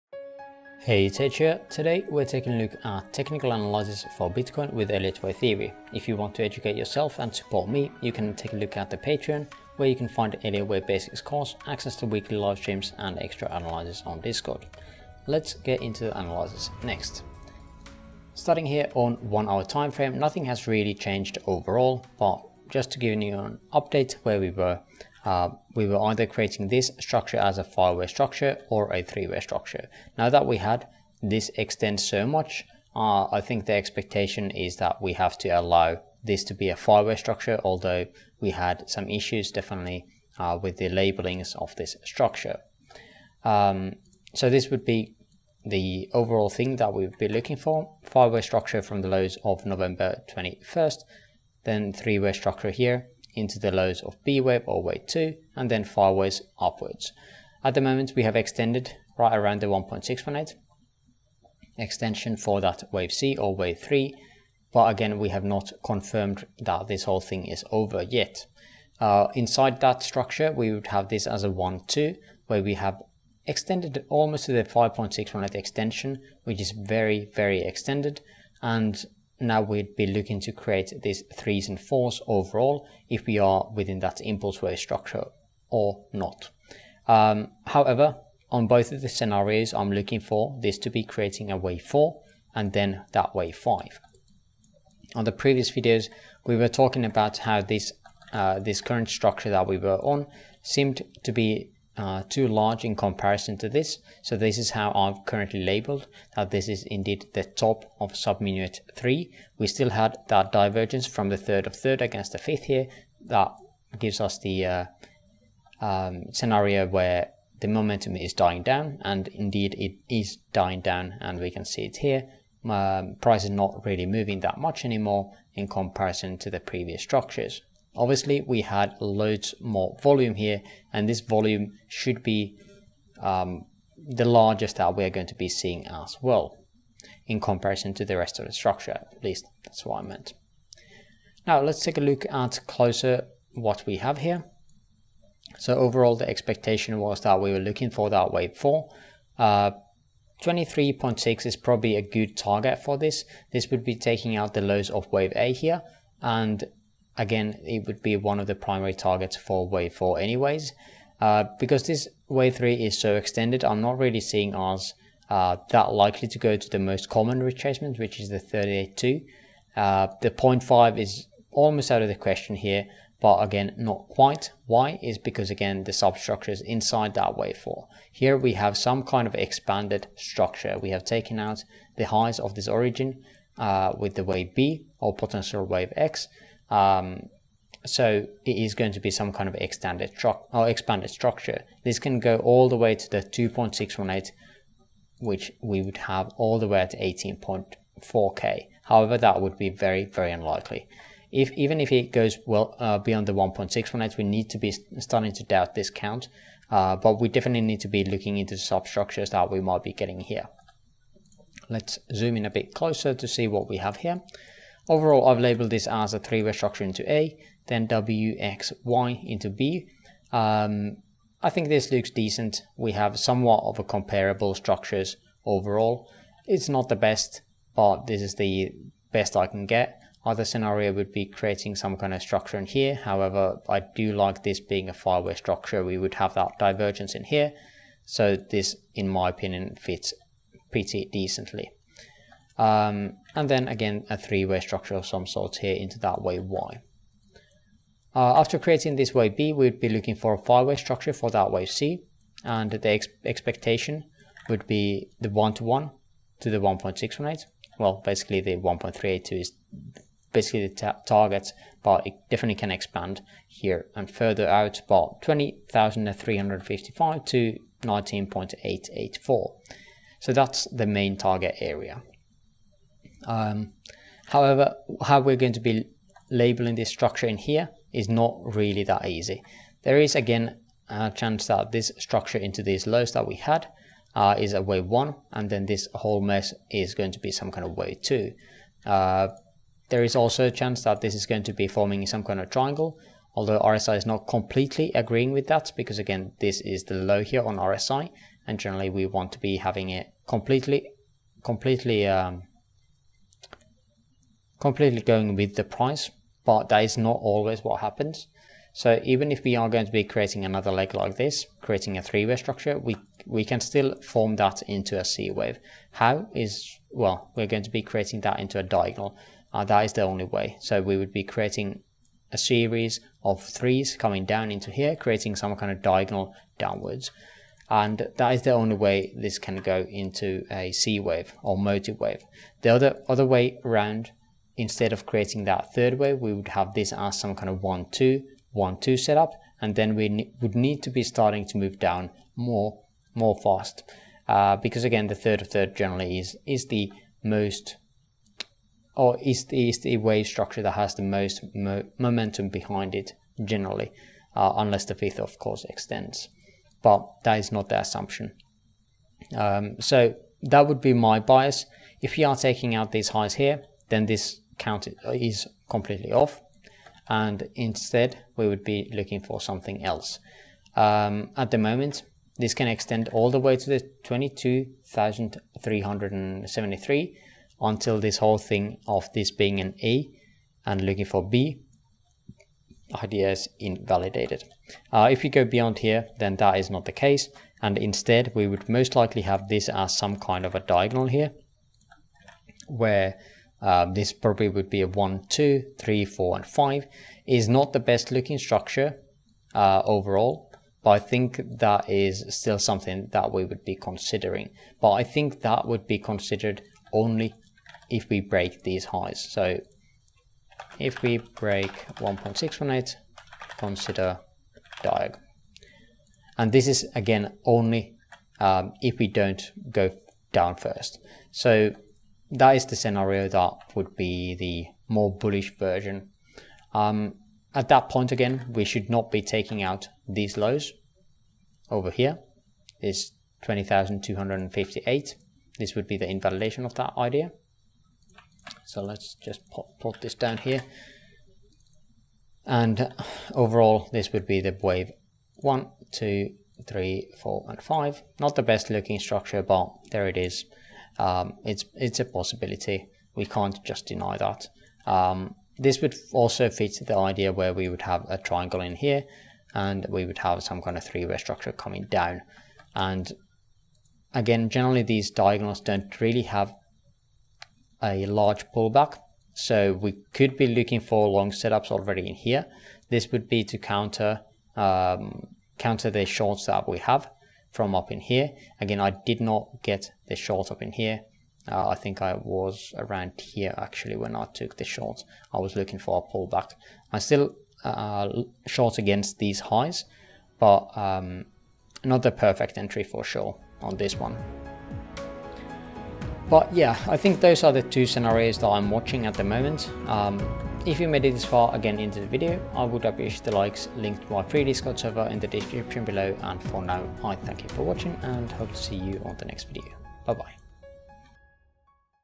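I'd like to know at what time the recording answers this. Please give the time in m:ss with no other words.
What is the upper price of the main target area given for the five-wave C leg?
4:25.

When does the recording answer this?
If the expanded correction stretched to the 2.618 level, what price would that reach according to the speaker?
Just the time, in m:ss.
3:16.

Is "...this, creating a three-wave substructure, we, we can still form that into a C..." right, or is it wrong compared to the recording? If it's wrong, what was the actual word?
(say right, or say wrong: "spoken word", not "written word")
wrong: "structure", not "substructure".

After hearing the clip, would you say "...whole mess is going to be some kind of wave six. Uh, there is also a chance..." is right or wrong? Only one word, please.
wrong.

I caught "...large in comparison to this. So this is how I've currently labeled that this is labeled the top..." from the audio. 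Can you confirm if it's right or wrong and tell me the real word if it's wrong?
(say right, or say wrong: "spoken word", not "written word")
wrong: "indeed", not "labeled".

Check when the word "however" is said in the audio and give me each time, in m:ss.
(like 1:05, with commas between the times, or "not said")
1:27, 3:18, 3:52, 4:34.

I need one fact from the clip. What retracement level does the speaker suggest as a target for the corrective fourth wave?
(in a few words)
23.6.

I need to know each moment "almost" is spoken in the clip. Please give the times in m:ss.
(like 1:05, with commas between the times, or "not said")
1:14, 2:51.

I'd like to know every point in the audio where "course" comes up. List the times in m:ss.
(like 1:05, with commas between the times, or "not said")
0:11, 5:55.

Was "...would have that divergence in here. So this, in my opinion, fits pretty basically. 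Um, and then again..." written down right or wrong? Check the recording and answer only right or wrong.
wrong.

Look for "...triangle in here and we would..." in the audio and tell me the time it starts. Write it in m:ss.
7:38.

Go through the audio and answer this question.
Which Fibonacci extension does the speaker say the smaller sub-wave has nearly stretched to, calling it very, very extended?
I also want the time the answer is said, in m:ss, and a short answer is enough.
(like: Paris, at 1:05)
5.618, at 1:14.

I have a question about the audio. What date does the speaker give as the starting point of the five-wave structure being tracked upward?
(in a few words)
November 21st.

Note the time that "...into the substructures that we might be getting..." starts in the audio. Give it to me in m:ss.
3:28.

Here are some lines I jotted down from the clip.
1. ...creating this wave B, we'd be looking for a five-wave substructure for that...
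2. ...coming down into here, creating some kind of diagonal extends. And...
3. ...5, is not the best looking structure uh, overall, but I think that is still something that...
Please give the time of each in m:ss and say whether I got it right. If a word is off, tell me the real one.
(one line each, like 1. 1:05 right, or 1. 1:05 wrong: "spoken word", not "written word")
1. 4:08 wrong: "structure", not "substructure"
2. 5:23 wrong: "downwards", not "extends"
3. 6:36 right.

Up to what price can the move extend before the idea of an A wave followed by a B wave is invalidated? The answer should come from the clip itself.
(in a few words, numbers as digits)
22,373.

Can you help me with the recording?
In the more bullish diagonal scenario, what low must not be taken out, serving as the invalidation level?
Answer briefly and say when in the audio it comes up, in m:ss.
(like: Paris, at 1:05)
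20,258, at 7:13.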